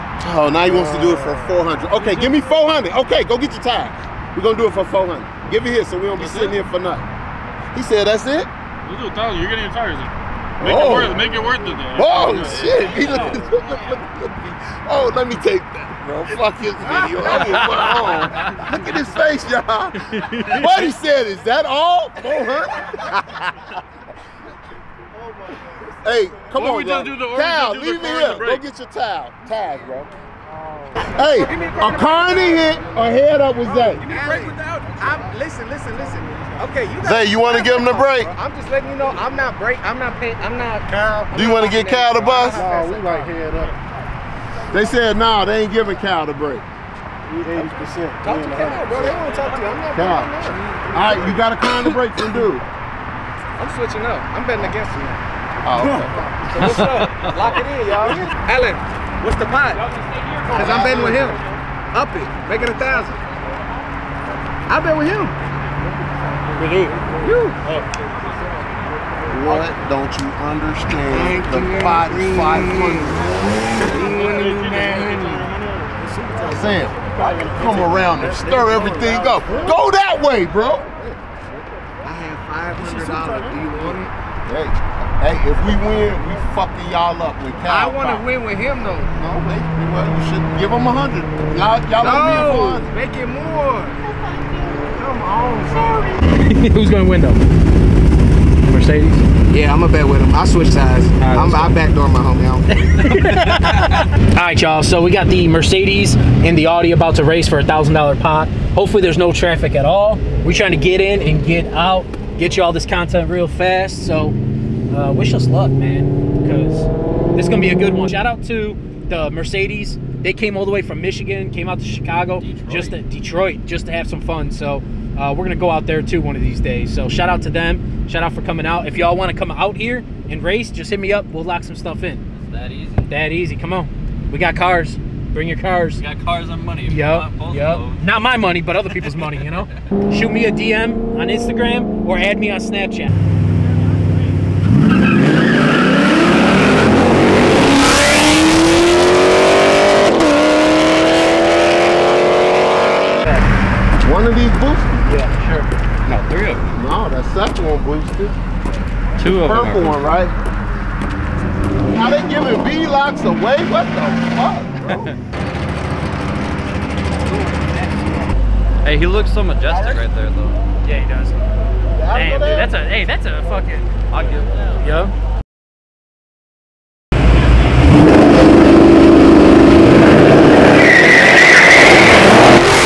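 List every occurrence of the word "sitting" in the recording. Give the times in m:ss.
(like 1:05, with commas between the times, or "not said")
0:06.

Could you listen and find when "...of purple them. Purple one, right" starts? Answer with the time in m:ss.
2:39.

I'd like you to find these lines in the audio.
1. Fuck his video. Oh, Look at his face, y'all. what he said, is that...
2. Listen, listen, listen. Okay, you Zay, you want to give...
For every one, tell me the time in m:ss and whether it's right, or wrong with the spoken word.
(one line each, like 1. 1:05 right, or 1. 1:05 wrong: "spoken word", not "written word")
1. 0:16 right
2. 0:35 right.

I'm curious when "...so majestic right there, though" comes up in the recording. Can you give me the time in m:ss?
2:49.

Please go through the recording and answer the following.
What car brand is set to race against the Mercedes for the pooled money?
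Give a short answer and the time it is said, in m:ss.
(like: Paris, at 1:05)
Audi, at 1:46.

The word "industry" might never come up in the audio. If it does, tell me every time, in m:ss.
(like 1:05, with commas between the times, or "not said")
not said.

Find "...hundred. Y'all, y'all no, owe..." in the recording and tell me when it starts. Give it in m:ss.
1:30.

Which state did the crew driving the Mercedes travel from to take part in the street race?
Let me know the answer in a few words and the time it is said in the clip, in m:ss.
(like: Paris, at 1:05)
Michigan, at 2:01.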